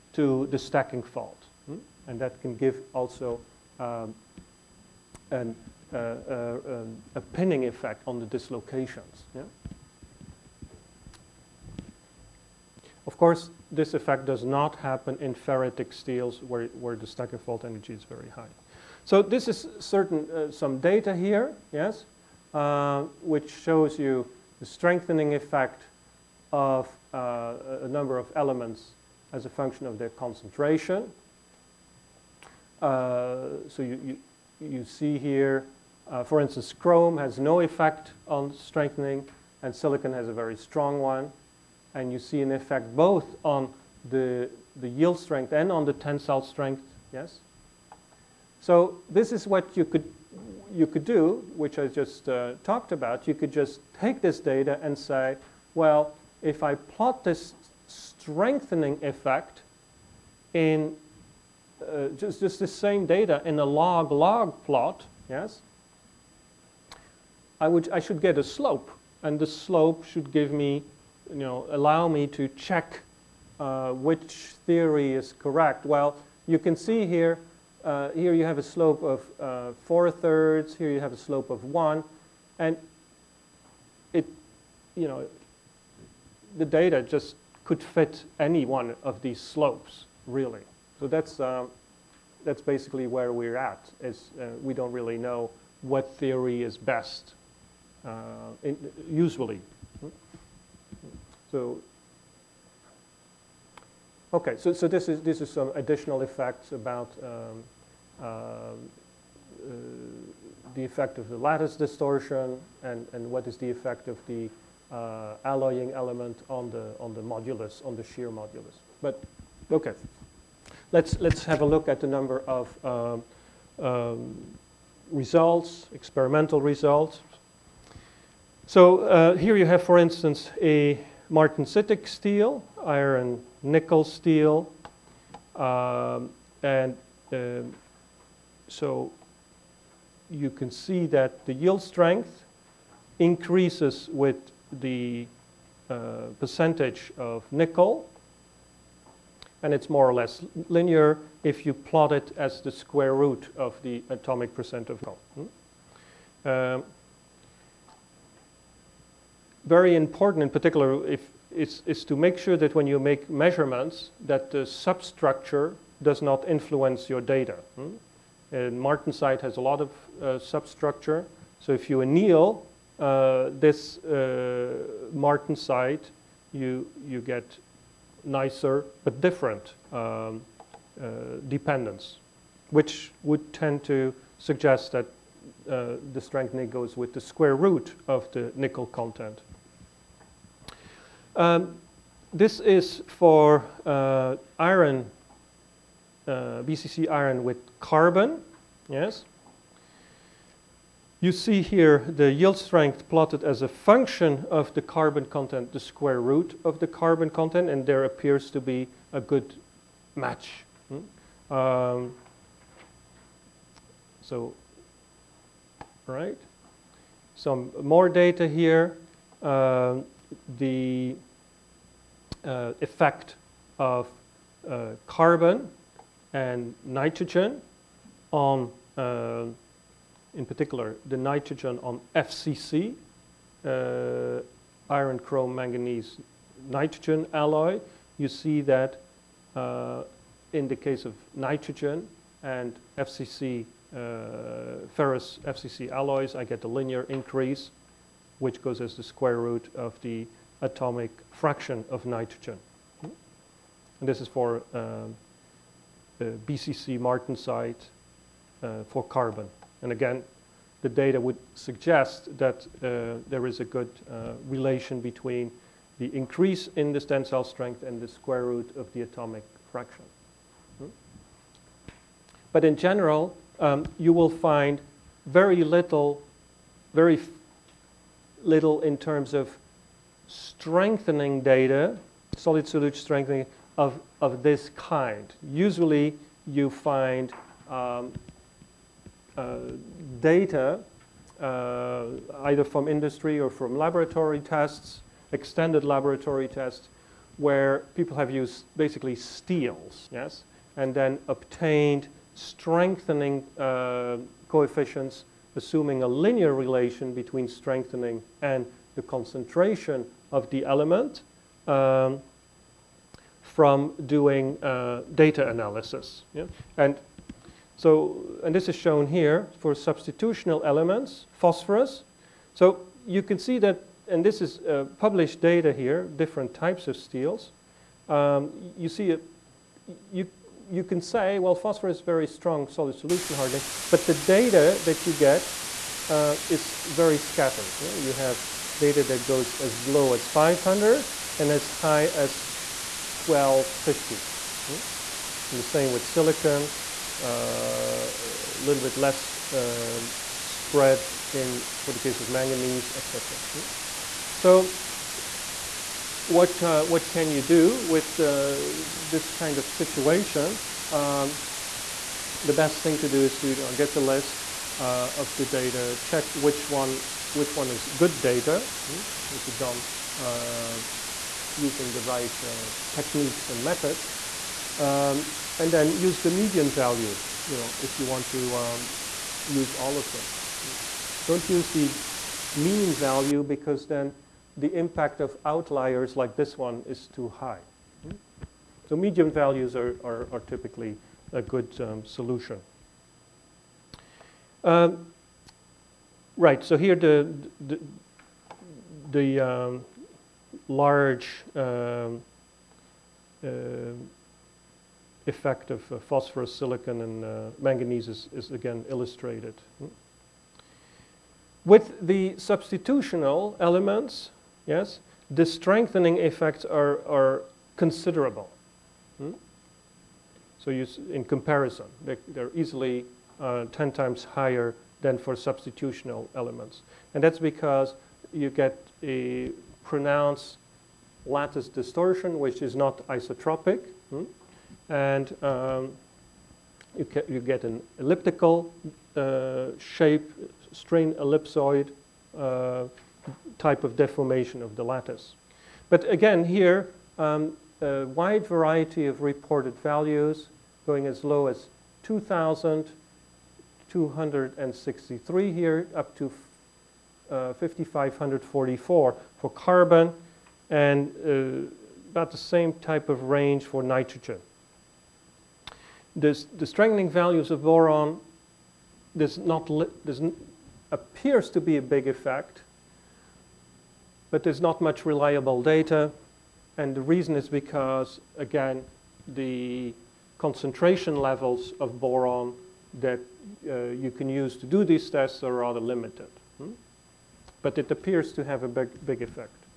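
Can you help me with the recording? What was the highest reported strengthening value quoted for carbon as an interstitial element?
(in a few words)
5,544.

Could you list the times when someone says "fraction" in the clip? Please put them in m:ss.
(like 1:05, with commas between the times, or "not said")
4:11, 4:29.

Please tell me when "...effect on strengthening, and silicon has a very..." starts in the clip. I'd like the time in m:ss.
0:37.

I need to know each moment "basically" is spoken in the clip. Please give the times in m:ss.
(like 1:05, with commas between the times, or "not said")
1:32, 4:58.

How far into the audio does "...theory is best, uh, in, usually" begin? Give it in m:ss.
1:36.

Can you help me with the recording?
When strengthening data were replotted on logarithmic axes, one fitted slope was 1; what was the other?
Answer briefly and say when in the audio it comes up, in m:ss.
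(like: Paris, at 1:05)
4/3, at 1:19.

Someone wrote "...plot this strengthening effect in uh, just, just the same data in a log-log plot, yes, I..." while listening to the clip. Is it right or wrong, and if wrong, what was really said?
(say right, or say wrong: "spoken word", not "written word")
right.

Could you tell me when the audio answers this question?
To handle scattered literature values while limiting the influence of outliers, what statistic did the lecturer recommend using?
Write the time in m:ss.
6:16.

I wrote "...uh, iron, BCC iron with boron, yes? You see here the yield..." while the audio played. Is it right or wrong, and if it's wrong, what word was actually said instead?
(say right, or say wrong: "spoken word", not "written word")
wrong: "carbon", not "boron".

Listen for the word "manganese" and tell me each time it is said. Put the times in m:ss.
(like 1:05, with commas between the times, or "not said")
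3:55, 5:52, 6:47.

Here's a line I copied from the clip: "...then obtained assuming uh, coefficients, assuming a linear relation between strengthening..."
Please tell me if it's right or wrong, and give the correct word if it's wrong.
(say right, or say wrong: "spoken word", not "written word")
wrong: "strengthening", not "assuming".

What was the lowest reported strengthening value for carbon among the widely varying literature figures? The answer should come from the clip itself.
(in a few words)
2,263.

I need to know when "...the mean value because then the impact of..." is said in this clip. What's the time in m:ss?
6:21.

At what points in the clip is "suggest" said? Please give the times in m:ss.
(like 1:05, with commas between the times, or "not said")
3:04, 4:21.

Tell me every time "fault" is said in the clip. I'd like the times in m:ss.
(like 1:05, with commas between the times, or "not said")
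0:01, 0:17.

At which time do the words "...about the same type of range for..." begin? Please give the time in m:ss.
7:42.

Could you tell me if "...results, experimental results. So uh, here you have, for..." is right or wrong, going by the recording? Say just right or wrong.
right.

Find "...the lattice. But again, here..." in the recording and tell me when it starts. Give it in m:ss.
7:24.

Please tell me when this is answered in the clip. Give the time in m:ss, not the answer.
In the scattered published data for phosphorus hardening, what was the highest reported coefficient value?
5:43.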